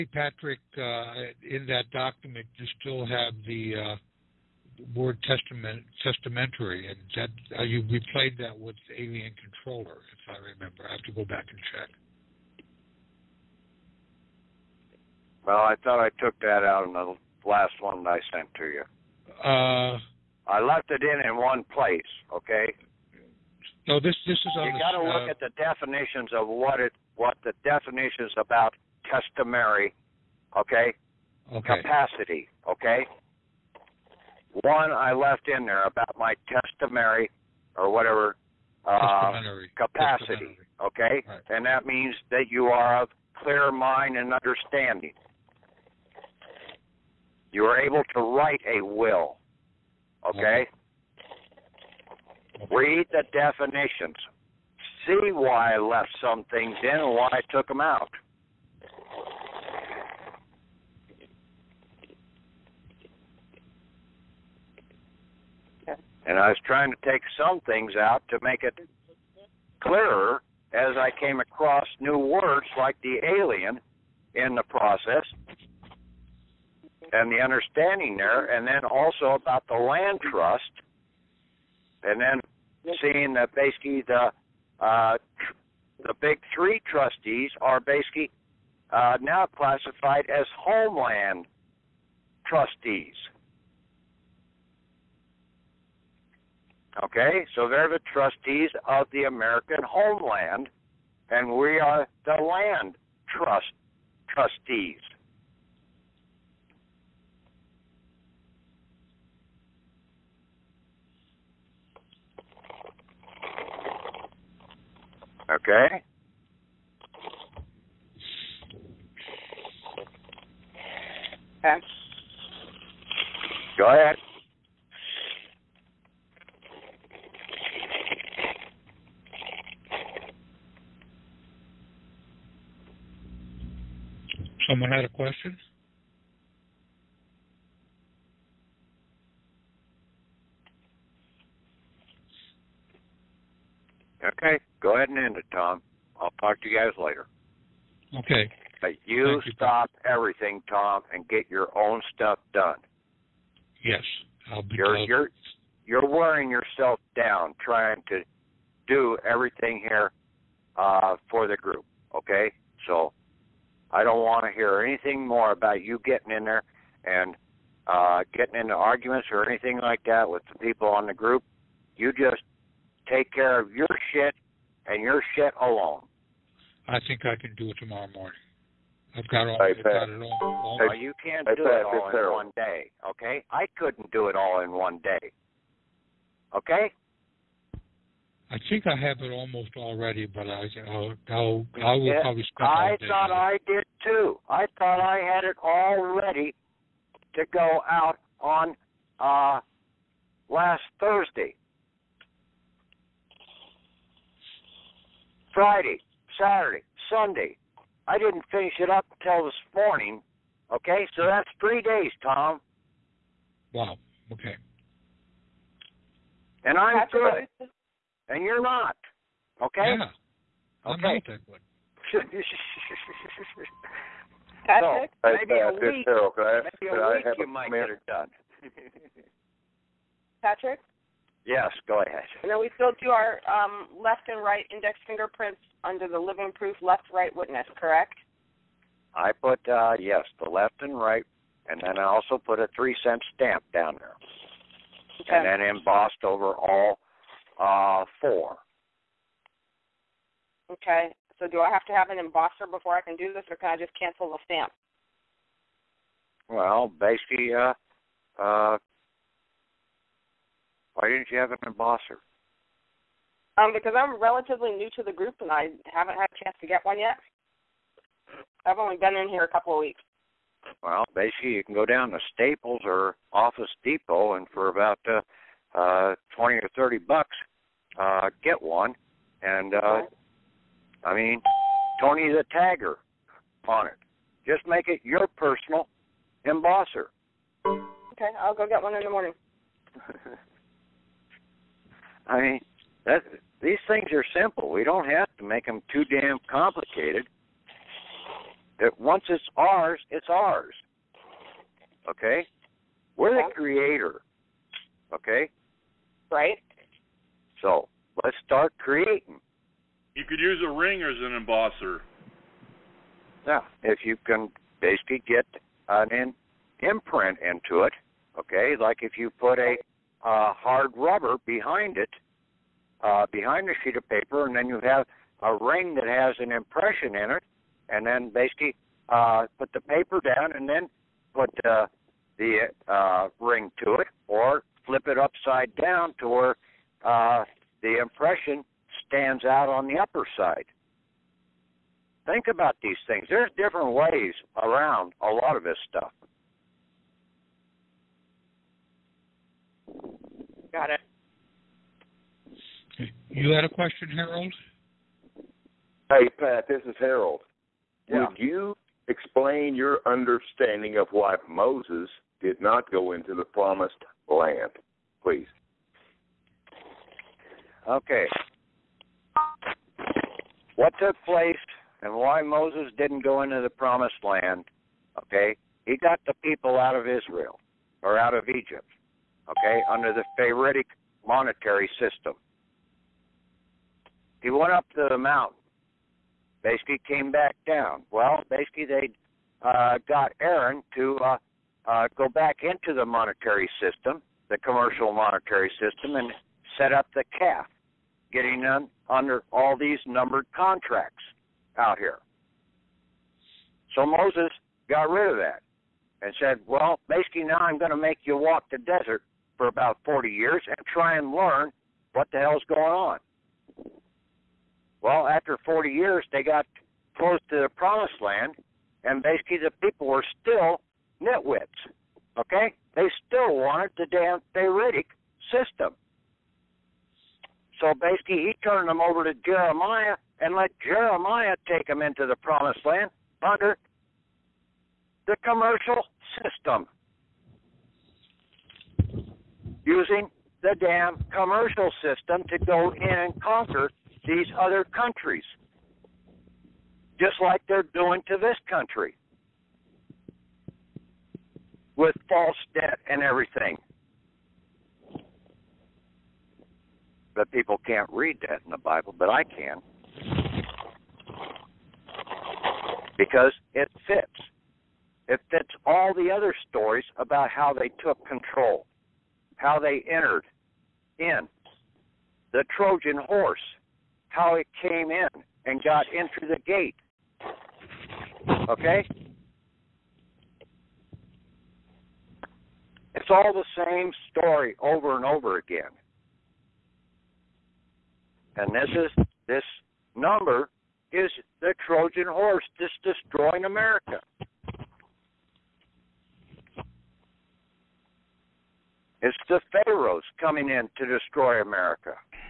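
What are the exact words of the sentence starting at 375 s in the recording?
He got the people out of Israel or out of Egypt, okay, under the Pharaonic monetary system.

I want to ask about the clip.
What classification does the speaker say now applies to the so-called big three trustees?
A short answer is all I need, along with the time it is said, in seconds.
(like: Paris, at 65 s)
homeland trustees, at 90 s.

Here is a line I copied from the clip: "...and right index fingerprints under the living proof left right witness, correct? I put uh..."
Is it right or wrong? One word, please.
right.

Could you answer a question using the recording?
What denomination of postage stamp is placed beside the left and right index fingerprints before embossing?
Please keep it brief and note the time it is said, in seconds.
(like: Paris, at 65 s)
three cent, at 242 s.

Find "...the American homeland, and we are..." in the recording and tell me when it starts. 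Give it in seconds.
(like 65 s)
99 s.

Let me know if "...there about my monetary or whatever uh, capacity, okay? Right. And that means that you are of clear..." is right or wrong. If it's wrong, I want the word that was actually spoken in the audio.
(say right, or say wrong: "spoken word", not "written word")
wrong: "customary", not "monetary".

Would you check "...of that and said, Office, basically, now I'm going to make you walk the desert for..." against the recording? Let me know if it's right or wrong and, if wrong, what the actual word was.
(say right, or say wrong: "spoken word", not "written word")
wrong: "Well", not "Office".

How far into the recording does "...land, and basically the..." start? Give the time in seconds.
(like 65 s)
418 s.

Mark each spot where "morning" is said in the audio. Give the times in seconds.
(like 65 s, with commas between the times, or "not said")
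178 s, 209 s, 289 s.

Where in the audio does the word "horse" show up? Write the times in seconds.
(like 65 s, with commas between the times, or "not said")
473 s, 492 s.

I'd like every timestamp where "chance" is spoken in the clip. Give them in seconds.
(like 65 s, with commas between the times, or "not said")
266 s.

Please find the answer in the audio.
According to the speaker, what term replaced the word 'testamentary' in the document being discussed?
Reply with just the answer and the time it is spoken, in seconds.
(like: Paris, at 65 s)
Alien Controller, at 8 s.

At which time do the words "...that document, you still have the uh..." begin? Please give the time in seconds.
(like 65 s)
1 s.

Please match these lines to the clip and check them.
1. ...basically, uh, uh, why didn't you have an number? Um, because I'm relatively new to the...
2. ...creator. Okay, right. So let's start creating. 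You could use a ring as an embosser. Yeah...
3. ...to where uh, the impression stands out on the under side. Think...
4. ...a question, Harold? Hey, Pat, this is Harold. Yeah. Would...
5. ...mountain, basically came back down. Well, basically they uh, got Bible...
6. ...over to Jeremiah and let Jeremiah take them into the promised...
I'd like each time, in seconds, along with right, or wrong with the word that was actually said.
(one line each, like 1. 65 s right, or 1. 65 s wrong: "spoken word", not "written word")
1. 256 s wrong: "embosser", not "number"
2. 303 s right
3. 336 s wrong: "upper", not "under"
4. 353 s right
5. 385 s wrong: "Aaron", not "Bible"
6. 429 s right.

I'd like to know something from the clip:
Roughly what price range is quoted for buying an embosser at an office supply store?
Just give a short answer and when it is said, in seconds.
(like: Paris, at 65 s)
$20 or $30, at 276 s.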